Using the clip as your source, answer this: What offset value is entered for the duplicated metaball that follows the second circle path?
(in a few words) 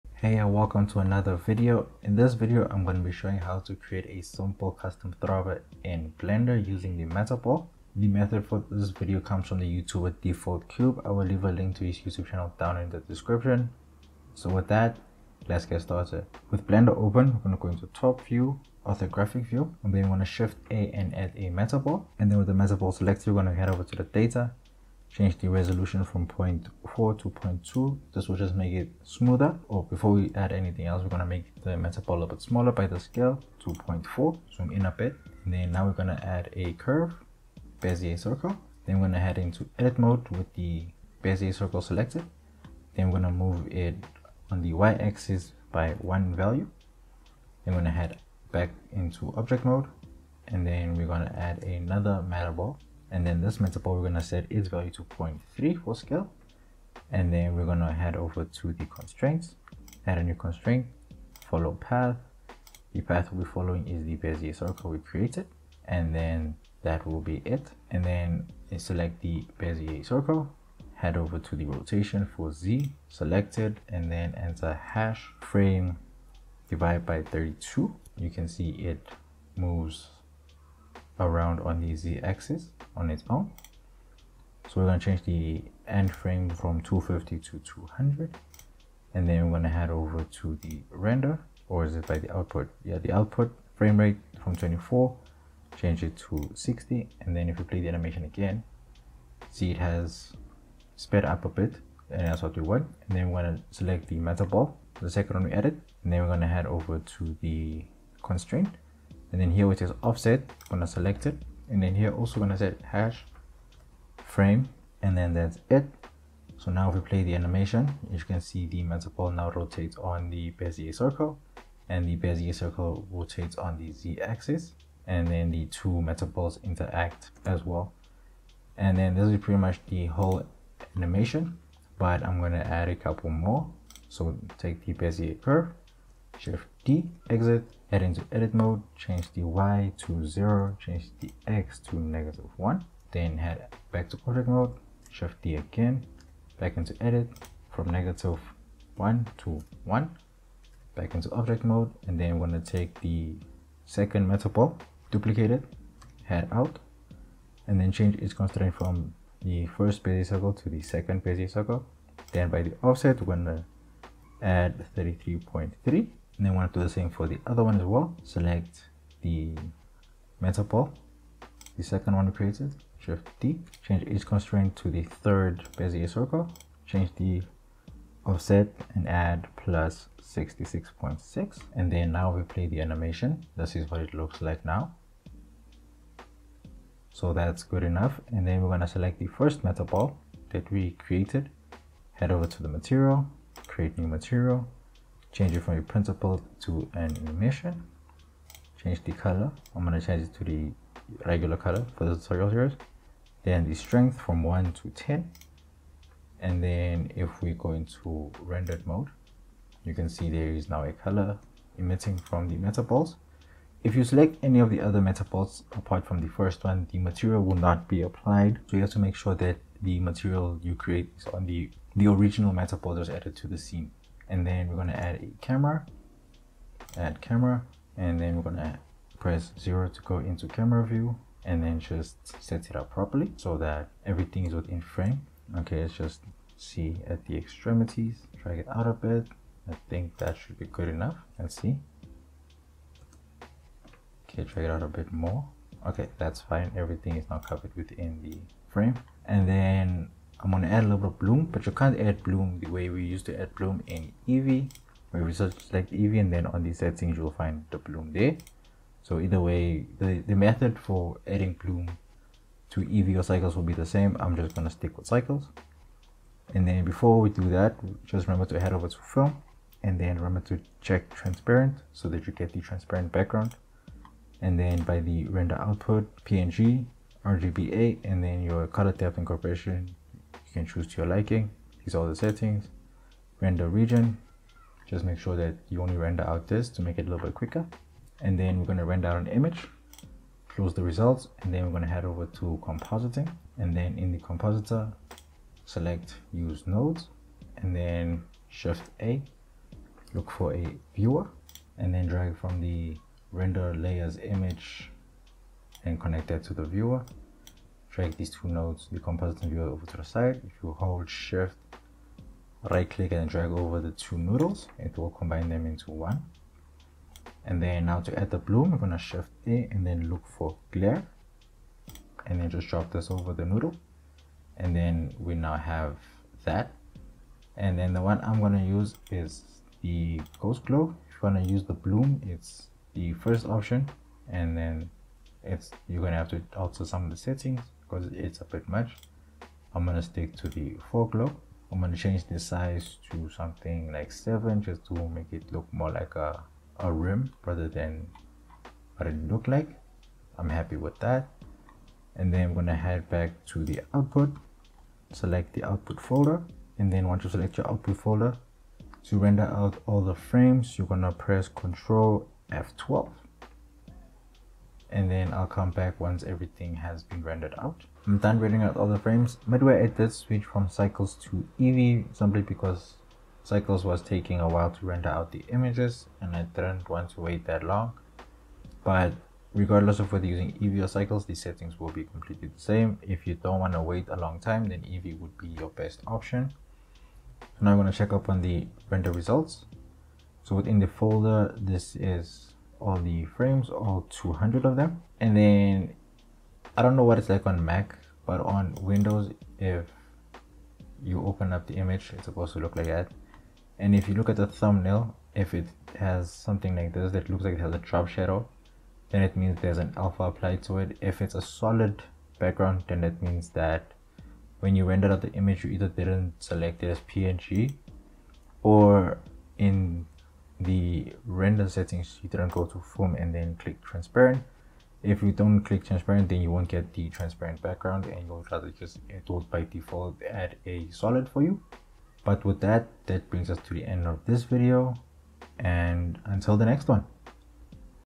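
33.3.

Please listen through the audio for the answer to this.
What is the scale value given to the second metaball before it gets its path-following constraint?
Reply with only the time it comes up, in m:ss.
0:55.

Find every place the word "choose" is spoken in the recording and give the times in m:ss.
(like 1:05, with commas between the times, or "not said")
4:40.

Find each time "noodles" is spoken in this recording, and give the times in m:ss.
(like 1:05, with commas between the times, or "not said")
5:14, 5:23.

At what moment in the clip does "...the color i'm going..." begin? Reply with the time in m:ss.
3:19.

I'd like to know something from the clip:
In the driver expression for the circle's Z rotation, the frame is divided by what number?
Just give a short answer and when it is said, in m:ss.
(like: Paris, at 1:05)
32, at 1:17.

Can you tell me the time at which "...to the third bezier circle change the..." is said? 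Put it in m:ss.
2:54.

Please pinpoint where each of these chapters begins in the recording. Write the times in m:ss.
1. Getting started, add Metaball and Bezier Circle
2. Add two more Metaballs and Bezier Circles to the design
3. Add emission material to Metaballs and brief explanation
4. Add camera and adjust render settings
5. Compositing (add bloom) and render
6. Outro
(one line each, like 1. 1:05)
1. 0:16
2. 2:14
3. 3:07
4. 3:44
5. 4:10
6. 7:06.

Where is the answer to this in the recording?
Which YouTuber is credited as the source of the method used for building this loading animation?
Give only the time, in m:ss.
0:10.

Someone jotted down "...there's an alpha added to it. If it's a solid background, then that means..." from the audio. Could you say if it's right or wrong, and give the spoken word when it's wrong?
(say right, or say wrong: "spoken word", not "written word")
wrong: "applied", not "added".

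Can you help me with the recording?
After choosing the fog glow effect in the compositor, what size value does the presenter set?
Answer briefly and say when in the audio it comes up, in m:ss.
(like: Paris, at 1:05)
7, at 5:44.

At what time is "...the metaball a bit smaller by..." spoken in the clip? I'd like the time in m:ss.
0:31.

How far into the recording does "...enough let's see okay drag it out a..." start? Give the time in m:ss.
4:00.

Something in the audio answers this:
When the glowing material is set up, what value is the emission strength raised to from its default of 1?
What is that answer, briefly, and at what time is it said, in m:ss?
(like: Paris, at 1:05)
10, at 3:24.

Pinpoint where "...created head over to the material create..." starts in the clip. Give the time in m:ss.
3:11.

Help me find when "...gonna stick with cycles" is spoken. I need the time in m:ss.
4:24.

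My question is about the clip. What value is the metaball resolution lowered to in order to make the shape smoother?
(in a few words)
0.2.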